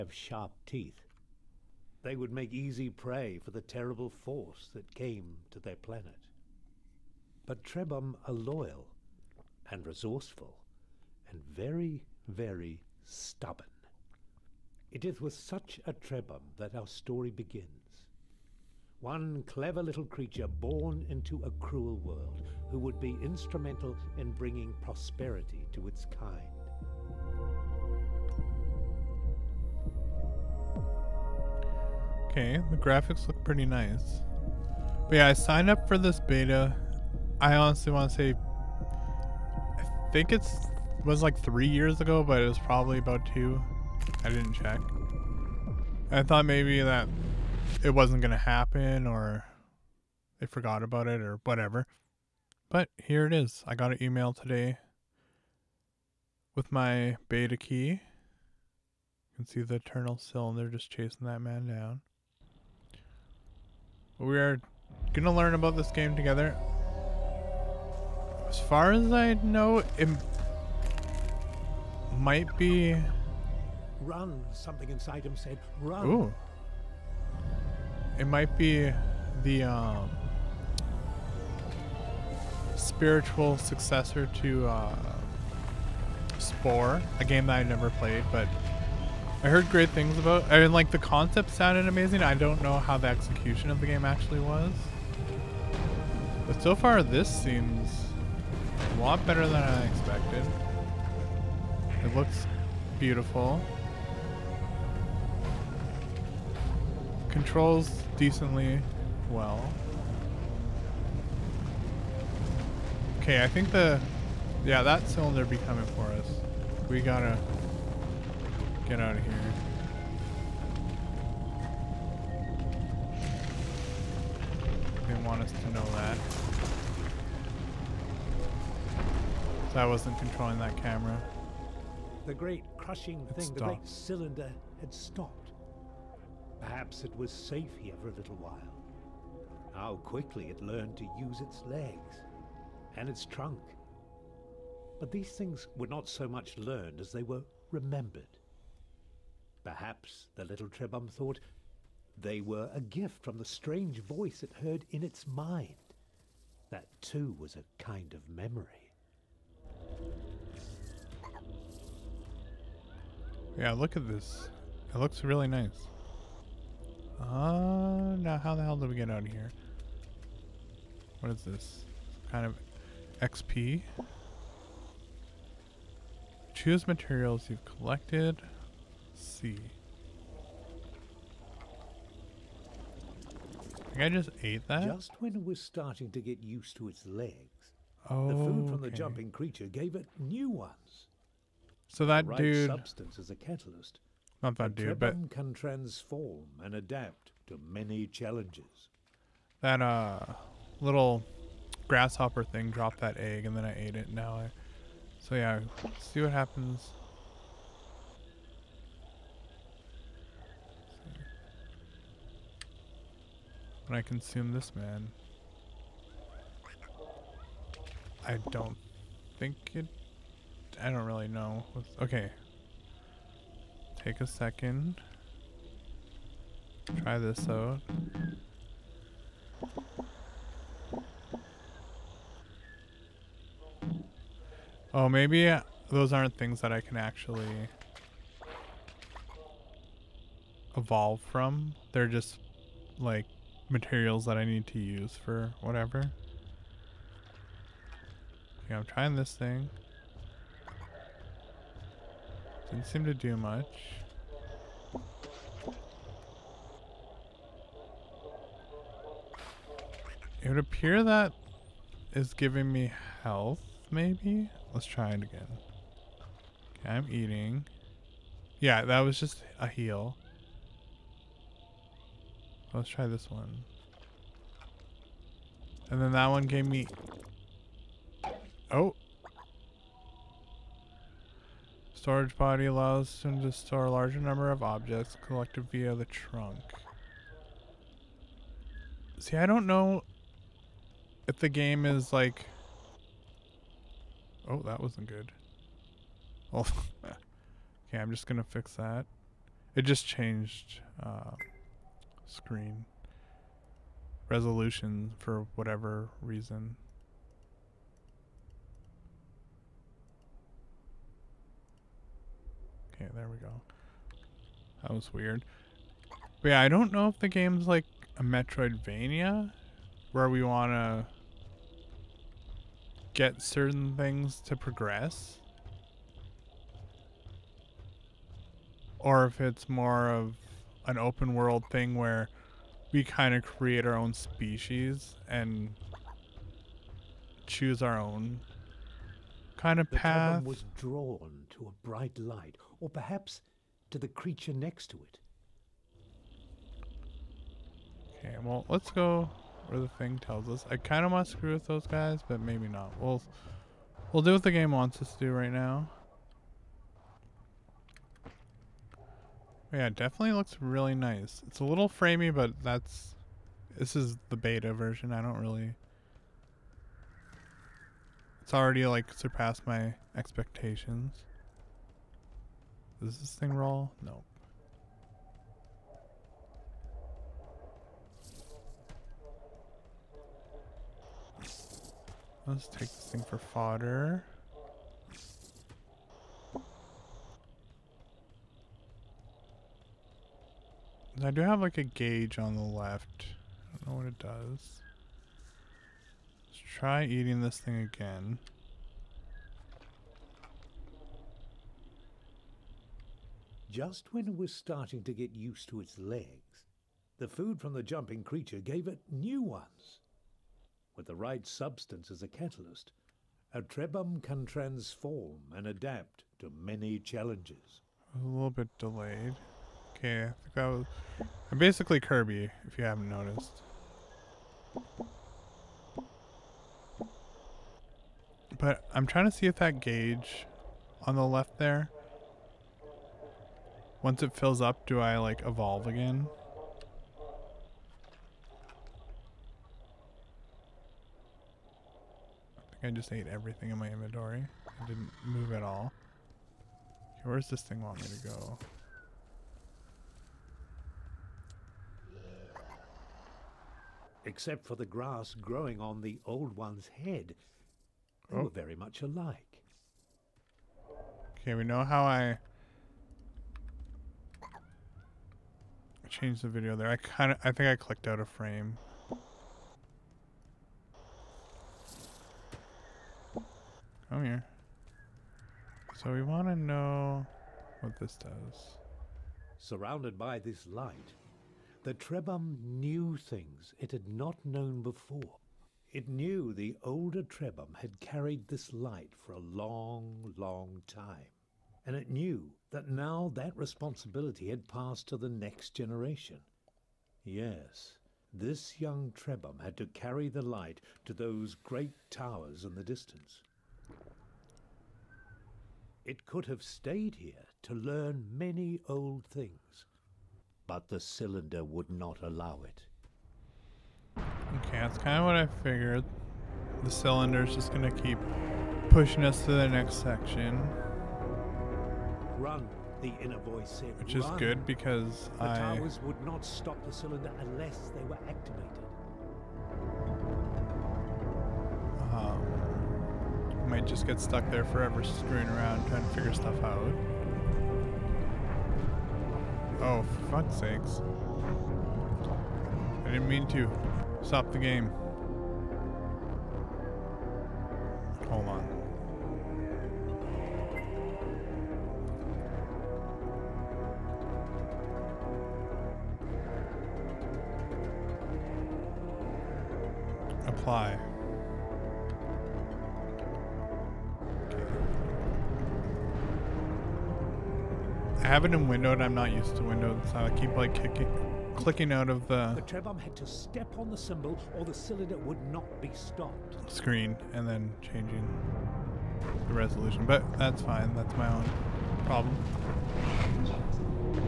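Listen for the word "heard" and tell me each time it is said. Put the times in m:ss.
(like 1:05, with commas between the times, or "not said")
1:29, 2:34.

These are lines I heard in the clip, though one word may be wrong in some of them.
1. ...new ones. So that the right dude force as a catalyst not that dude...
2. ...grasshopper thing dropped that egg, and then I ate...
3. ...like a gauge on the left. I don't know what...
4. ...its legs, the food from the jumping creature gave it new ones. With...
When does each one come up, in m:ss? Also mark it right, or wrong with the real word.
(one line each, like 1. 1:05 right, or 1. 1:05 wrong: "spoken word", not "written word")
1. 3:10 wrong: "substance", not "force"
2. 3:21 right
3. 6:31 right
4. 6:45 right.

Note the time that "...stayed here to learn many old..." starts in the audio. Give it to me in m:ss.
8:26.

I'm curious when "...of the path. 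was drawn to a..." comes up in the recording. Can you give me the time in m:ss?
5:39.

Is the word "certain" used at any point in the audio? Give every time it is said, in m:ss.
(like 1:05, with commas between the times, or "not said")
5:23.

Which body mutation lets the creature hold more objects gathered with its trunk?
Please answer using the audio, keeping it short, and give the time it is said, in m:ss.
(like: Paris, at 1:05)
Storage body, at 4:42.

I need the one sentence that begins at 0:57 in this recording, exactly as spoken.
You can see the eternal cylinder just chasing that man down.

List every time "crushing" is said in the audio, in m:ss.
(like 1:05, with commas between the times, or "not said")
2:12.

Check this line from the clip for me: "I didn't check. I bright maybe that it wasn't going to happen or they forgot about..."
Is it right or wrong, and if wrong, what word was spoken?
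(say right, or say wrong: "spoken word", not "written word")
wrong: "thought", not "bright".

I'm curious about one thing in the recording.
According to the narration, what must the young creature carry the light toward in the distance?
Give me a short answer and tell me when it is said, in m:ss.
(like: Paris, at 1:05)
great towers, at 8:21.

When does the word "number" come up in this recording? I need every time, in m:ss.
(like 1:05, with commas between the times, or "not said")
4:44.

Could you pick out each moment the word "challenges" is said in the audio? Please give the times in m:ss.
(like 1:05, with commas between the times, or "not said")
3:18, 6:56.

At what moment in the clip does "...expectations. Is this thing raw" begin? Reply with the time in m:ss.
6:10.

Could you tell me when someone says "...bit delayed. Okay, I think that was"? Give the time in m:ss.
6:58.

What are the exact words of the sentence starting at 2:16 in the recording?
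Perhaps it was safe here for a little while.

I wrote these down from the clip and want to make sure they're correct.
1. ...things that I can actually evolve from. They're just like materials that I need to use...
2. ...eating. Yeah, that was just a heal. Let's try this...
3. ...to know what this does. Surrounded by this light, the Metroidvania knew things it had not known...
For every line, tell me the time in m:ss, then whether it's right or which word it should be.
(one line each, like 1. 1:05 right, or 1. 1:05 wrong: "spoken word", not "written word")
1. 3:56 right
2. 4:27 right
3. 7:56 wrong: "Trebhum", not "Metroidvania".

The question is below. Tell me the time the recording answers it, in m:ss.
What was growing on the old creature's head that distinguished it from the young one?
7:34.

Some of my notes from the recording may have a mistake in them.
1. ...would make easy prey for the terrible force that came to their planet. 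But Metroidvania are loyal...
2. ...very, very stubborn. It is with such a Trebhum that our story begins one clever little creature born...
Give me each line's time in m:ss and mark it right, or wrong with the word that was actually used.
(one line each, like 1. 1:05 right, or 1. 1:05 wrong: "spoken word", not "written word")
1. 0:02 wrong: "Trebhum", not "Metroidvania"
2. 0:11 right.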